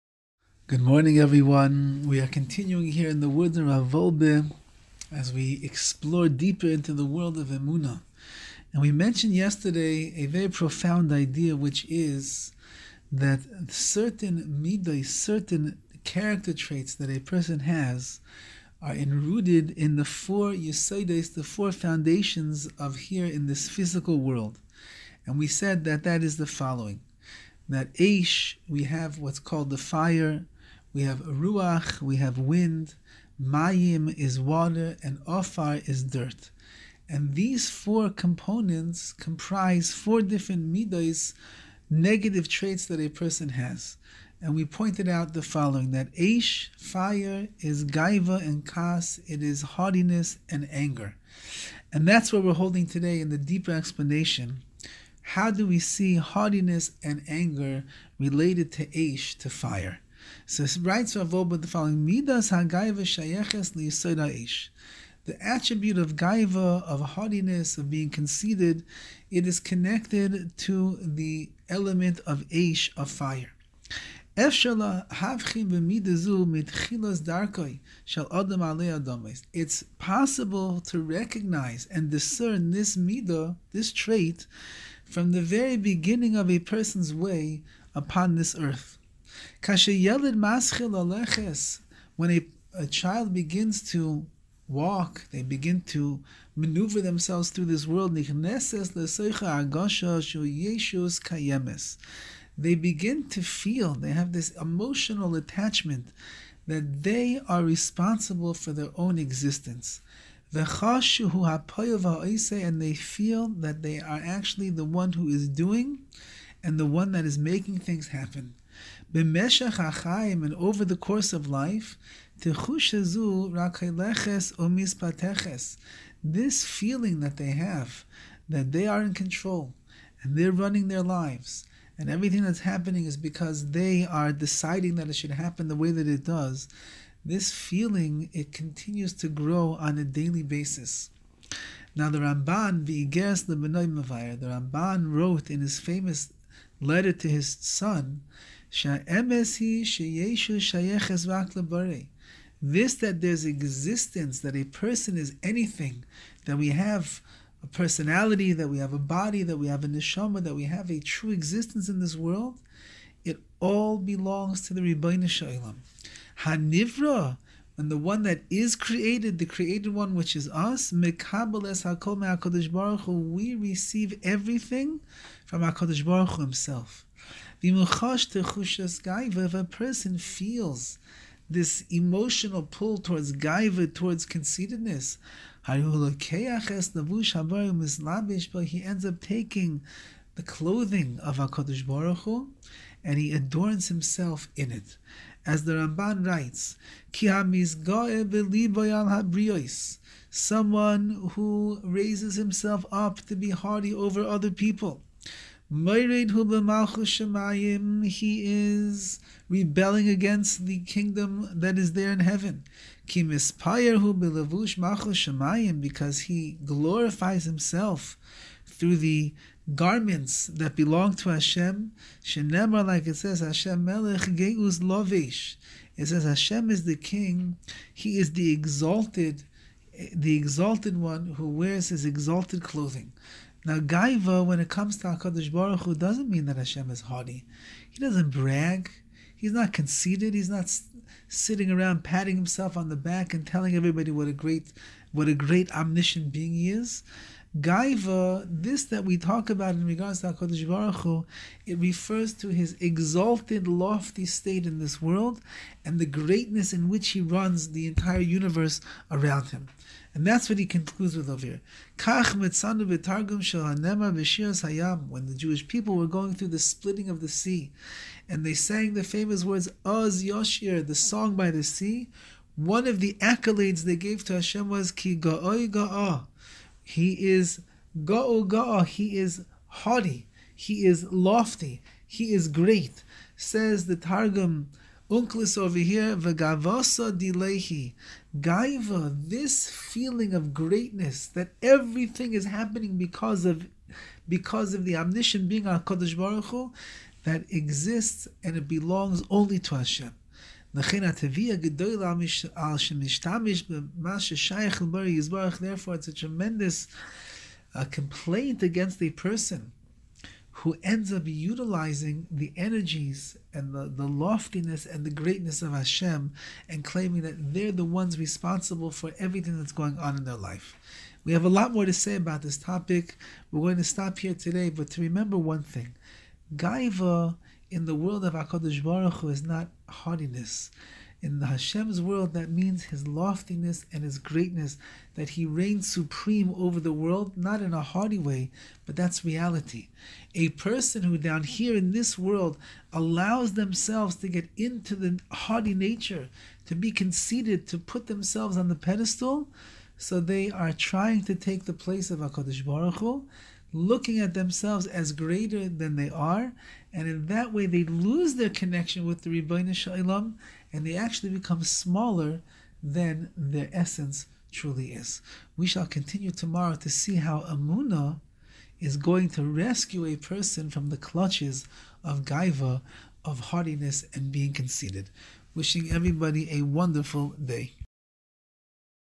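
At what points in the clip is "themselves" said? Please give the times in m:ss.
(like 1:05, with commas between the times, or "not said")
1:37, 5:43, 5:48, 5:54.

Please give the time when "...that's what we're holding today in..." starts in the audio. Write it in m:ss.
0:52.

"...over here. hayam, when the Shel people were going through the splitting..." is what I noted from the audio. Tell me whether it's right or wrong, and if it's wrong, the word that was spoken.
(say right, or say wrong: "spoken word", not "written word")
wrong: "Jewish", not "Shel".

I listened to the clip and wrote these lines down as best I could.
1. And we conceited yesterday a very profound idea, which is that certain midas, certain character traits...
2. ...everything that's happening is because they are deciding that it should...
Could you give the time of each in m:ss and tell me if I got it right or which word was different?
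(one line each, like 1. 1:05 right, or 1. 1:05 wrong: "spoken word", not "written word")
1. 0:08 wrong: "mentioned", not "conceited"
2. 2:12 right.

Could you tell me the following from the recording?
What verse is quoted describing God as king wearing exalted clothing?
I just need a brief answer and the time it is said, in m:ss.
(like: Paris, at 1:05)
Hashem melech geus lovish, at 3:43.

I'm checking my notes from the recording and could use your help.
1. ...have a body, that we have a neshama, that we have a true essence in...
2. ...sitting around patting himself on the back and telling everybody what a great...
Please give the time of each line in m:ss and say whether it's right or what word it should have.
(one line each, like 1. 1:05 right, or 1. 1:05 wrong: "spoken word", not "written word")
1. 2:38 wrong: "existence", not "essence"
2. 4:01 right.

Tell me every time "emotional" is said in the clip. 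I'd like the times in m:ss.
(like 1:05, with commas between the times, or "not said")
1:44, 3:01.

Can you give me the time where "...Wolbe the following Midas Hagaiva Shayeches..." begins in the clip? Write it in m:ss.
1:01.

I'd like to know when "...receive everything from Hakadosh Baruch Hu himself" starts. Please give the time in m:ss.
2:53.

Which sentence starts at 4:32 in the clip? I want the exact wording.
One of the accolades they gave to Hashem was Ki ga'oi ga'a.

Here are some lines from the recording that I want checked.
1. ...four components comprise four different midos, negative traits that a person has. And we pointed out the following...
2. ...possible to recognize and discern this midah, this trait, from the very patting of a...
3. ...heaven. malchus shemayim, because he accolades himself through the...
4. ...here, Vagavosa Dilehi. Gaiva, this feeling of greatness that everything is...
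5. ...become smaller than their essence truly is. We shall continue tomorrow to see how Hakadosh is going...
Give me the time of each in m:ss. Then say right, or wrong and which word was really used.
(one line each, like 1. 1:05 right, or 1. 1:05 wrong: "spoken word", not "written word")
1. 0:37 right
2. 1:19 wrong: "beginning", not "patting"
3. 3:32 wrong: "glorifies", not "accolades"
4. 4:45 right
5. 6:01 wrong: "Emunah", not "Hakadosh".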